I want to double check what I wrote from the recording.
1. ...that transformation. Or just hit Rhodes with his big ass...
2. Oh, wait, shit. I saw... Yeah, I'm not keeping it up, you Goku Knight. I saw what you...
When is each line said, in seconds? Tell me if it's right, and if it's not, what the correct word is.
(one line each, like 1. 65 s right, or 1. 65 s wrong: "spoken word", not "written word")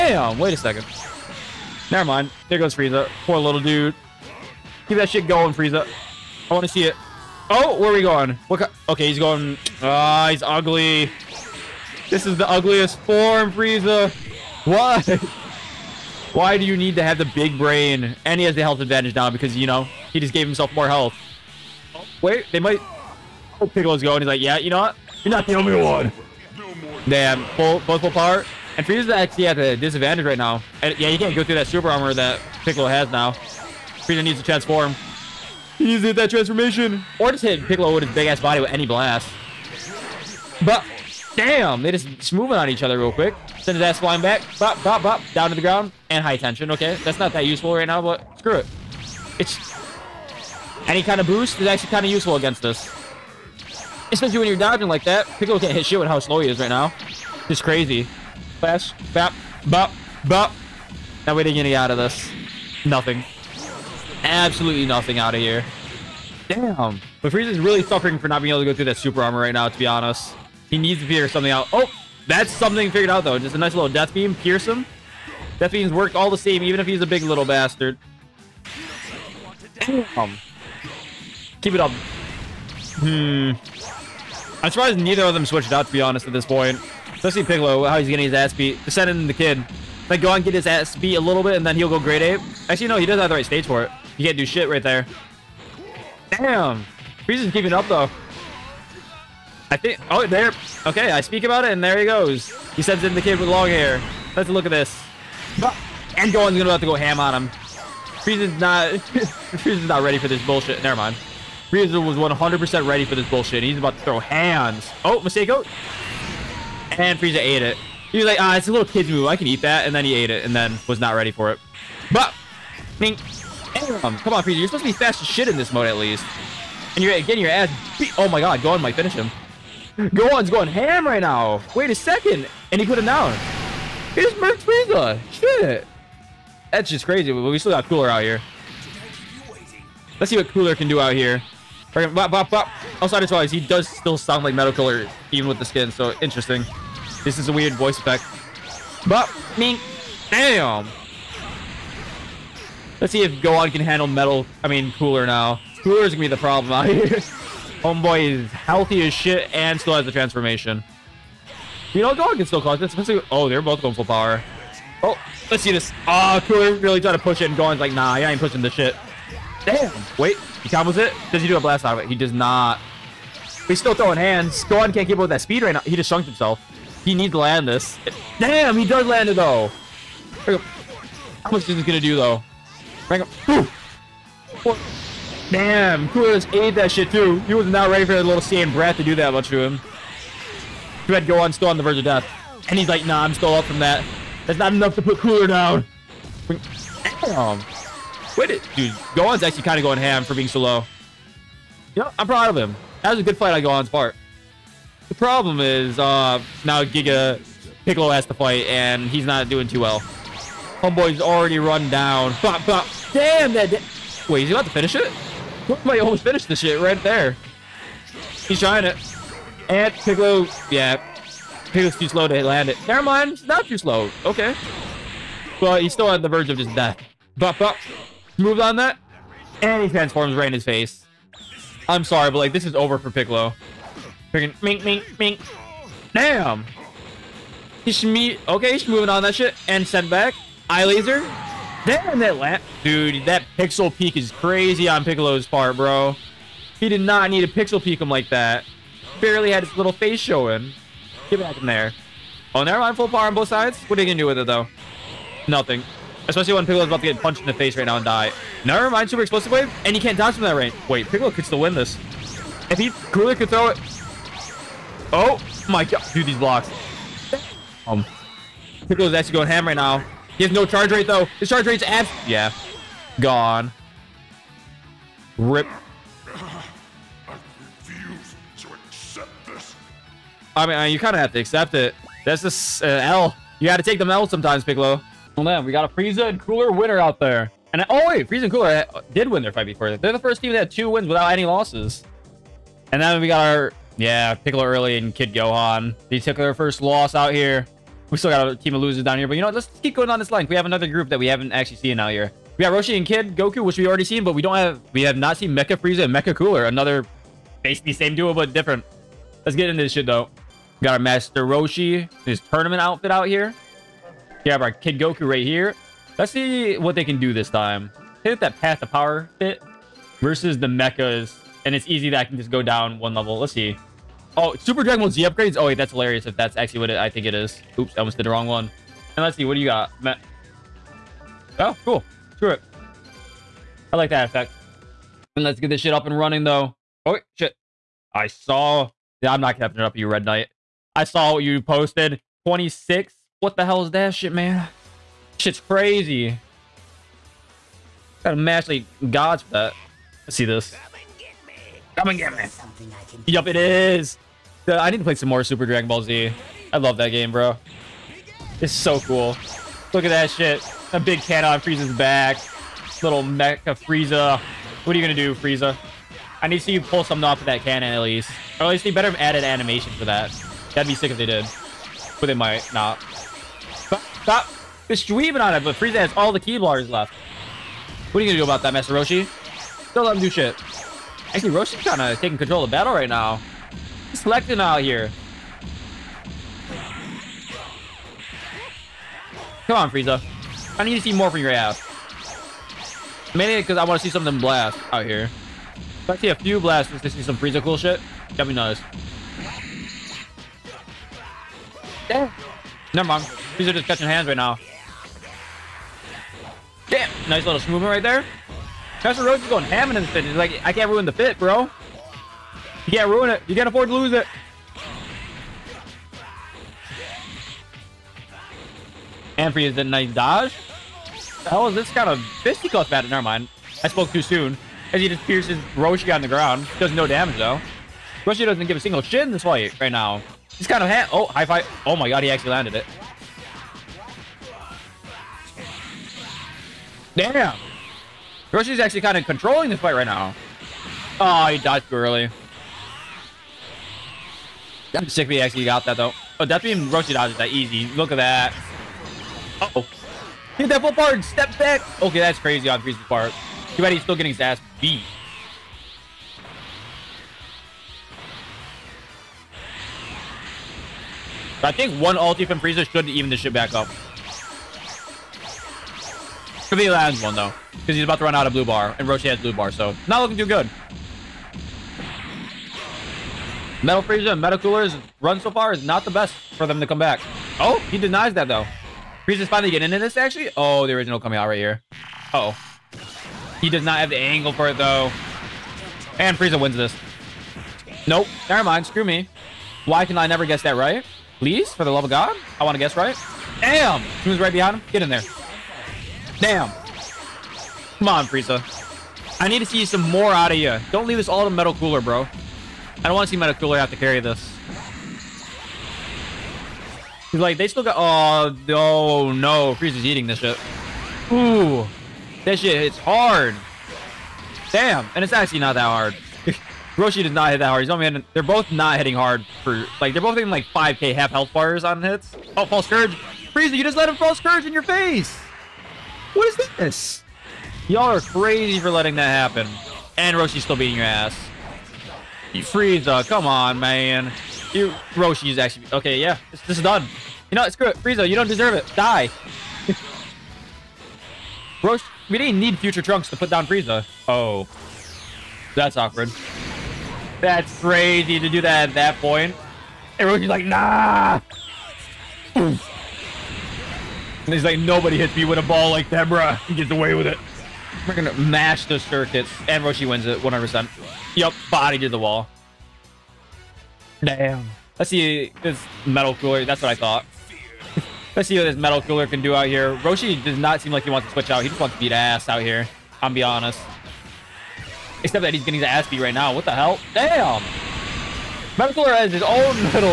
1. 36 s wrong: "Piccolo", not "Rhodes"
2. 337 s wrong: "Red", not "Goku".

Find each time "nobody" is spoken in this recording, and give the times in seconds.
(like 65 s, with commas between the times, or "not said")
554 s.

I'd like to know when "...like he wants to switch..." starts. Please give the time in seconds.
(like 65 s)
570 s.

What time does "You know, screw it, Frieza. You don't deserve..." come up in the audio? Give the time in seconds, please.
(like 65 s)
537 s.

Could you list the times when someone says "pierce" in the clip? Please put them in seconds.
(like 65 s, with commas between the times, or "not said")
74 s, 425 s.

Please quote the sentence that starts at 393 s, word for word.
Mainly because I want to see something blast out here.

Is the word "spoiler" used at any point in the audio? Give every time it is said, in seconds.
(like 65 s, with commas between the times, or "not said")
not said.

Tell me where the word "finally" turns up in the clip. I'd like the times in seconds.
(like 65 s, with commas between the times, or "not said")
479 s.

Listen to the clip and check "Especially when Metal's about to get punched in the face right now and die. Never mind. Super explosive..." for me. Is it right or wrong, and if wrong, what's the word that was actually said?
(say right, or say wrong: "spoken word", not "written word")
wrong: "Piccolo", not "Metal".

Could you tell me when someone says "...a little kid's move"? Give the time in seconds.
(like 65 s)
118 s.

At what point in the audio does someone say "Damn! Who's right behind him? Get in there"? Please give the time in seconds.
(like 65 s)
493 s.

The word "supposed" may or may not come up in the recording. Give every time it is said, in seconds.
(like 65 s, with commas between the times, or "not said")
124 s.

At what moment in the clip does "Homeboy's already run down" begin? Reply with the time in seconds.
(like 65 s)
210 s.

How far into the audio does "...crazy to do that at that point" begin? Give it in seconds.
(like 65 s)
547 s.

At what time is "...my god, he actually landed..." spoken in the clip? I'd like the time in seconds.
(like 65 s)
431 s.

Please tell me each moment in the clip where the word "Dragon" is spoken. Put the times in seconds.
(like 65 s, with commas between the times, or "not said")
324 s, 355 s.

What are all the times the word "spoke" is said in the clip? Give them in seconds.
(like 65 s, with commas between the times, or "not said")
423 s.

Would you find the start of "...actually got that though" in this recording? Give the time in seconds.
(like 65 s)
445 s.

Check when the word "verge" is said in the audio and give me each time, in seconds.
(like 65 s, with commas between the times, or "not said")
191 s, 226 s.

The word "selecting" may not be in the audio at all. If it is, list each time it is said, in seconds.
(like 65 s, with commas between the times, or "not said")
384 s.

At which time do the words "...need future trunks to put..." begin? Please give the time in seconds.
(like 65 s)
542 s.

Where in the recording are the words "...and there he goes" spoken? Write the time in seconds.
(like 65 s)
101 s.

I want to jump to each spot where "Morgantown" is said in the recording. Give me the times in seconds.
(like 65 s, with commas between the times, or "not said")
not said.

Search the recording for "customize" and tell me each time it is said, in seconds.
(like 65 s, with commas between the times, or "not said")
not said.